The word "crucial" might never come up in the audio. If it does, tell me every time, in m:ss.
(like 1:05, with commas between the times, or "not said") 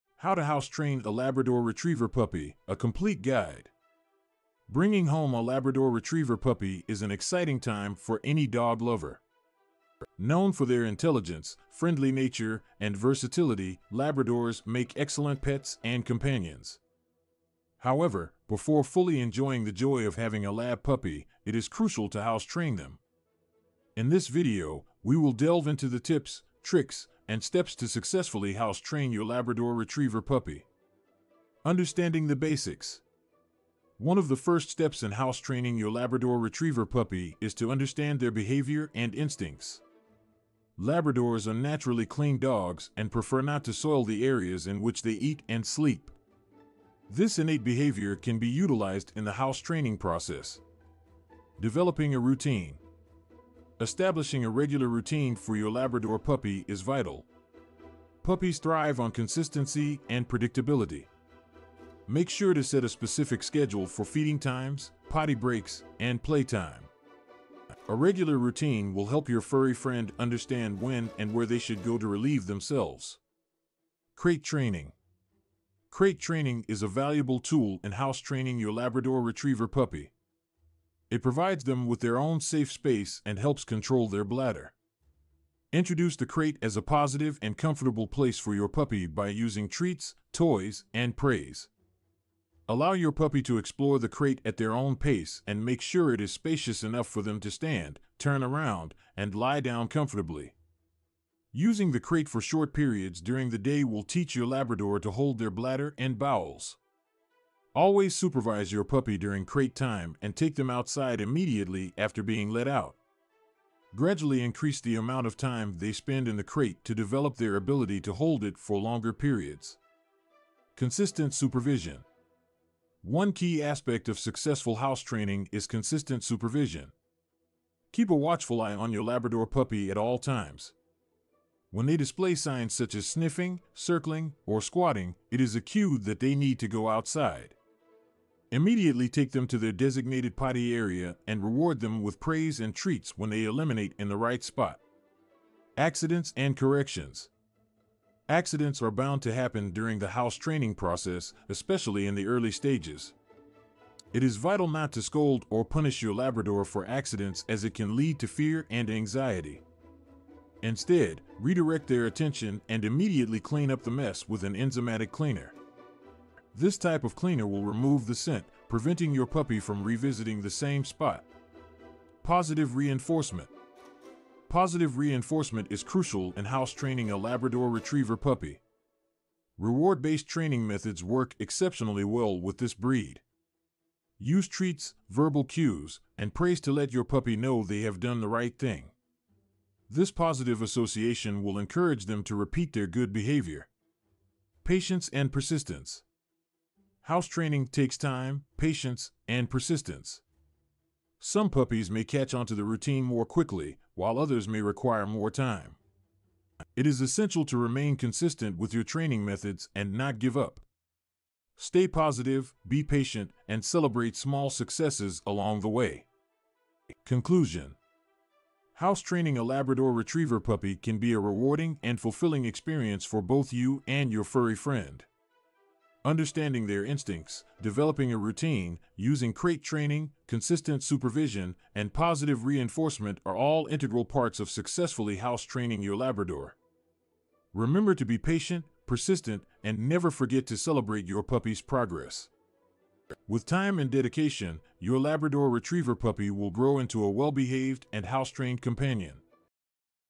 0:21, 2:55.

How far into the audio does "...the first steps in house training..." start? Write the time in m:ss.
0:34.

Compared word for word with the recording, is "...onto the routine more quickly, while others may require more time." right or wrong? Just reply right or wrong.
right.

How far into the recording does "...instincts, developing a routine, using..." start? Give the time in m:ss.
3:46.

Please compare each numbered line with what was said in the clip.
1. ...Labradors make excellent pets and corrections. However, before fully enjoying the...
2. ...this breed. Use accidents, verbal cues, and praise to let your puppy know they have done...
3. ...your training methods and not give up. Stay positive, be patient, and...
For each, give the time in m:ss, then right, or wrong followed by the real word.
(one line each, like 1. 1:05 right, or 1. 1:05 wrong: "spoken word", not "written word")
1. 0:13 wrong: "companions", not "corrections"
2. 3:02 wrong: "treats", not "accidents"
3. 3:28 right.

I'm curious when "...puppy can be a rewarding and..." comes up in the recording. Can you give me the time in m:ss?
3:40.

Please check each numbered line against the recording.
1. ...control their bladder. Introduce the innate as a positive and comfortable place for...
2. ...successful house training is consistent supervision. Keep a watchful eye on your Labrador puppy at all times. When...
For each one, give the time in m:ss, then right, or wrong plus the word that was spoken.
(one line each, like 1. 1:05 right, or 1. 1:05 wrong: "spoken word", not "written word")
1. 1:23 wrong: "crate", not "innate"
2. 2:04 right.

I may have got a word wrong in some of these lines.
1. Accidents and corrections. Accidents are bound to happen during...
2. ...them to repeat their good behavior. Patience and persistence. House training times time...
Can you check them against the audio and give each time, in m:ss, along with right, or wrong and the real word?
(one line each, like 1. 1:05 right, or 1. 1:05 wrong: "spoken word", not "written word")
1. 2:25 right
2. 3:12 wrong: "takes", not "times".